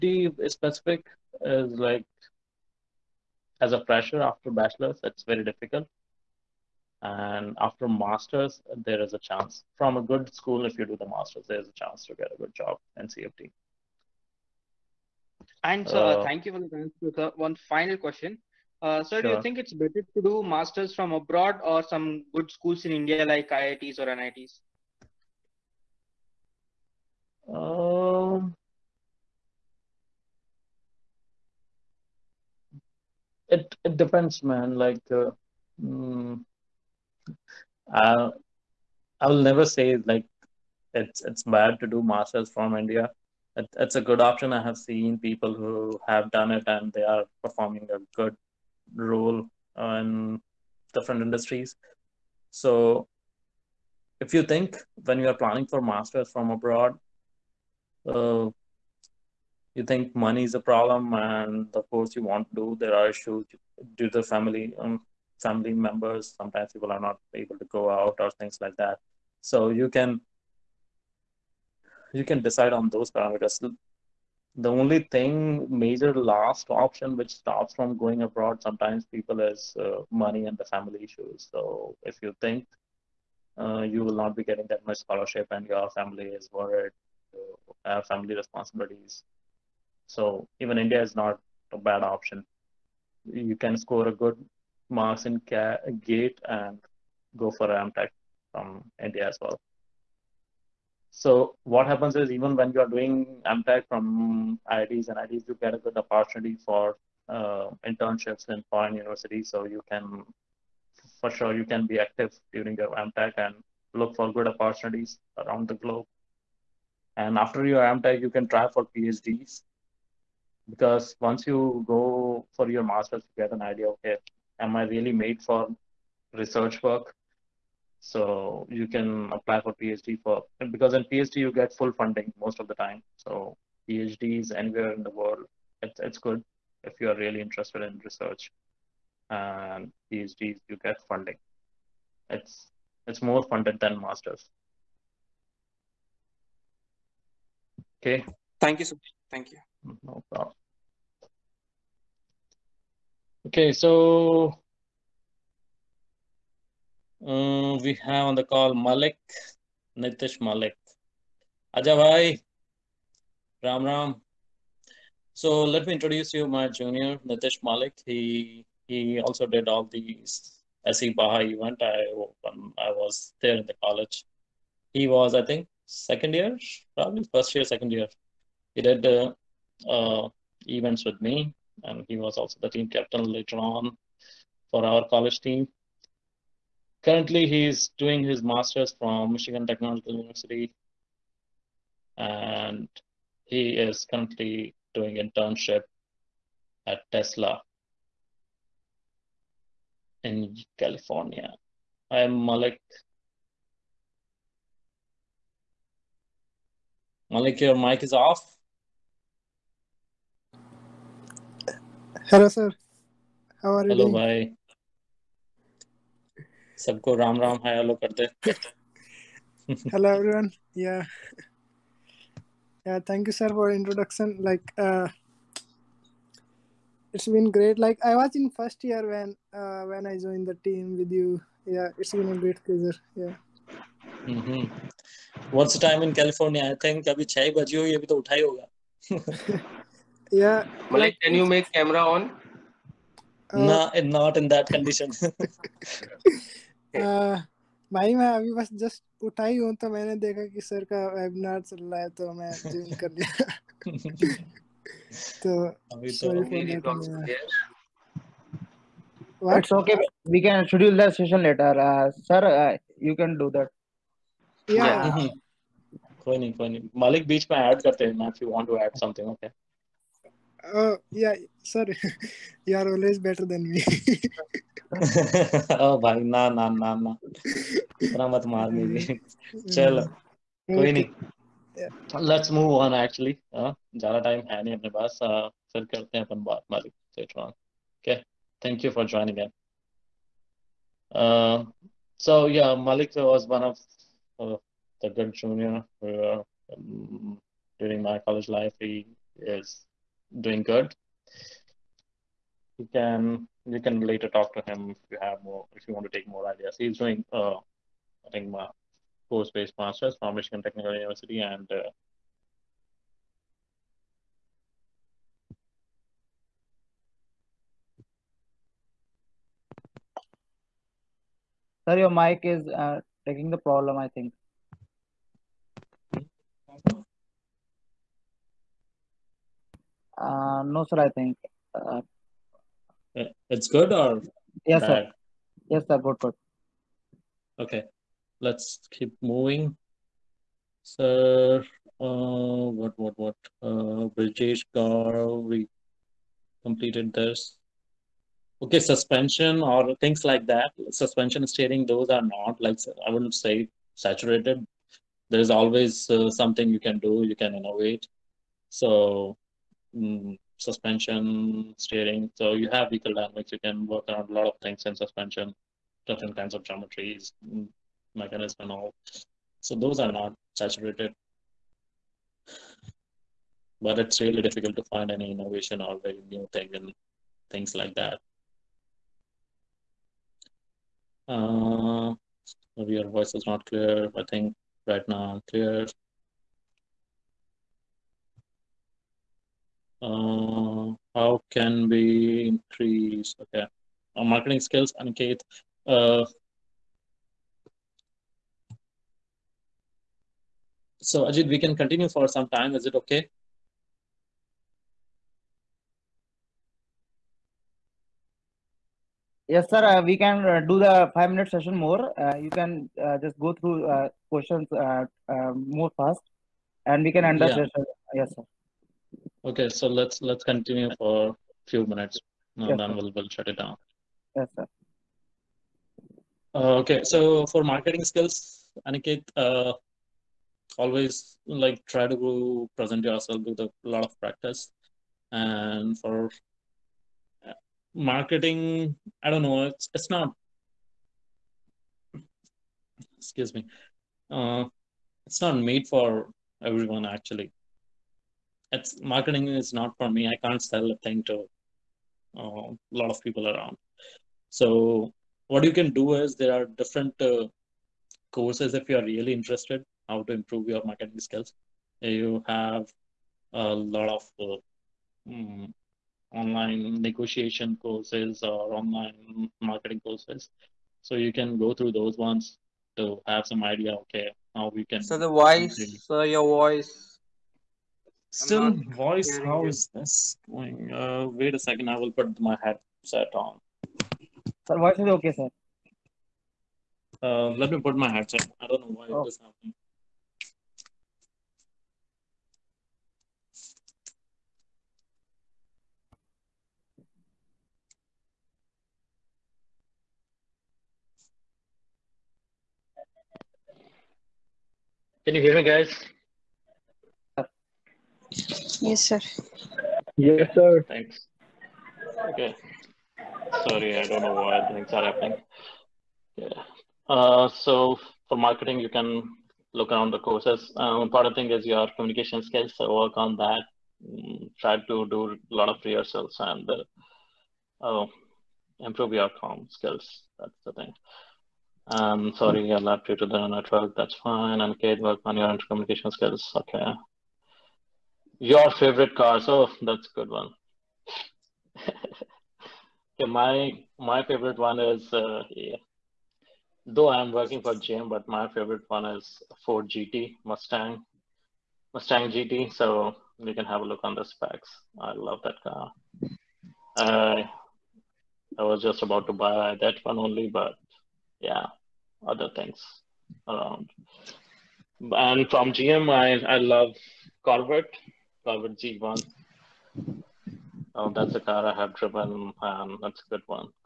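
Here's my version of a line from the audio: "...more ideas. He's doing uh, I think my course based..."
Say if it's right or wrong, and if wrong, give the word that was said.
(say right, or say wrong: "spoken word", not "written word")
right.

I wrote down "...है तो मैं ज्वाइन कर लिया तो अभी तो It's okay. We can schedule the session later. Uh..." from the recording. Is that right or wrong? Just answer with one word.
right.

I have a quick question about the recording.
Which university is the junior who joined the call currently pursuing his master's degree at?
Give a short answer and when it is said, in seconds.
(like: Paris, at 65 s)
Michigan Technological University, at 189 s.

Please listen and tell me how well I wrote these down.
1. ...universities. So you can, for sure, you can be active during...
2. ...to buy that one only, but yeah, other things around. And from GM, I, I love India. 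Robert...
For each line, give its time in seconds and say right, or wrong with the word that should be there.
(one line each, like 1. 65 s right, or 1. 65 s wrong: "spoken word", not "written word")
1. 108 s right
2. 559 s wrong: "Corvette", not "India".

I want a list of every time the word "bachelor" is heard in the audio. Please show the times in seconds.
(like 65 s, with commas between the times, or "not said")
4 s.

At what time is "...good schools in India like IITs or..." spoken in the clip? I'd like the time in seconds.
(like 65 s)
22 s.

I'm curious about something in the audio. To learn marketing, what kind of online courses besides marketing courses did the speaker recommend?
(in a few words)
Negotiation courses.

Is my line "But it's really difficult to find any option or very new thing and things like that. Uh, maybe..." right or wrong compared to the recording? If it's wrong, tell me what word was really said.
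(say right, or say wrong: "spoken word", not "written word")
wrong: "innovation", not "option".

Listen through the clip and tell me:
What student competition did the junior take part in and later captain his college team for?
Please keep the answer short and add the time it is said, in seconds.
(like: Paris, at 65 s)
SAE Baja, at 170 s.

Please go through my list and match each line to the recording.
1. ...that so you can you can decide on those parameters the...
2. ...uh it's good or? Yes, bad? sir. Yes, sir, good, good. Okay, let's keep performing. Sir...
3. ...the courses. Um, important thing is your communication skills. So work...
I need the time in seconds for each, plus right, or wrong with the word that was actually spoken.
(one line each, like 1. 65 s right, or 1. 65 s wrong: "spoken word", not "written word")
1. 68 s right
2. 333 s wrong: "moving", not "performing"
3. 520 s right.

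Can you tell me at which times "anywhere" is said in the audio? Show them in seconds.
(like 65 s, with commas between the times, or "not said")
134 s.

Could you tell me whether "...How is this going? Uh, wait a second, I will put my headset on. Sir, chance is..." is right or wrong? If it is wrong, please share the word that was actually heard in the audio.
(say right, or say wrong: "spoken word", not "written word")
wrong: "voice", not "chance".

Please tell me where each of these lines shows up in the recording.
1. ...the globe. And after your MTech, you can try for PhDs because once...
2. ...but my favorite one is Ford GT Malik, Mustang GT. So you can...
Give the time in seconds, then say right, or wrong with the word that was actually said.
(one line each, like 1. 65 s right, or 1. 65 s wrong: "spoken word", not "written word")
1. 115 s right
2. 548 s wrong: "Mustang", not "Malik".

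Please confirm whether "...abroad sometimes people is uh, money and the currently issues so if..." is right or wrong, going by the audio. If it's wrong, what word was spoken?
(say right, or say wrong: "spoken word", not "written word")
wrong: "family", not "currently".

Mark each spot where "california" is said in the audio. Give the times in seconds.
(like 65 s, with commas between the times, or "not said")
200 s, 236 s.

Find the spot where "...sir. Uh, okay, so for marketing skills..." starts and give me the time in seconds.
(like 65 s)
424 s.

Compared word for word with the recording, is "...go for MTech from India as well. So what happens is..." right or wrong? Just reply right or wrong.
right.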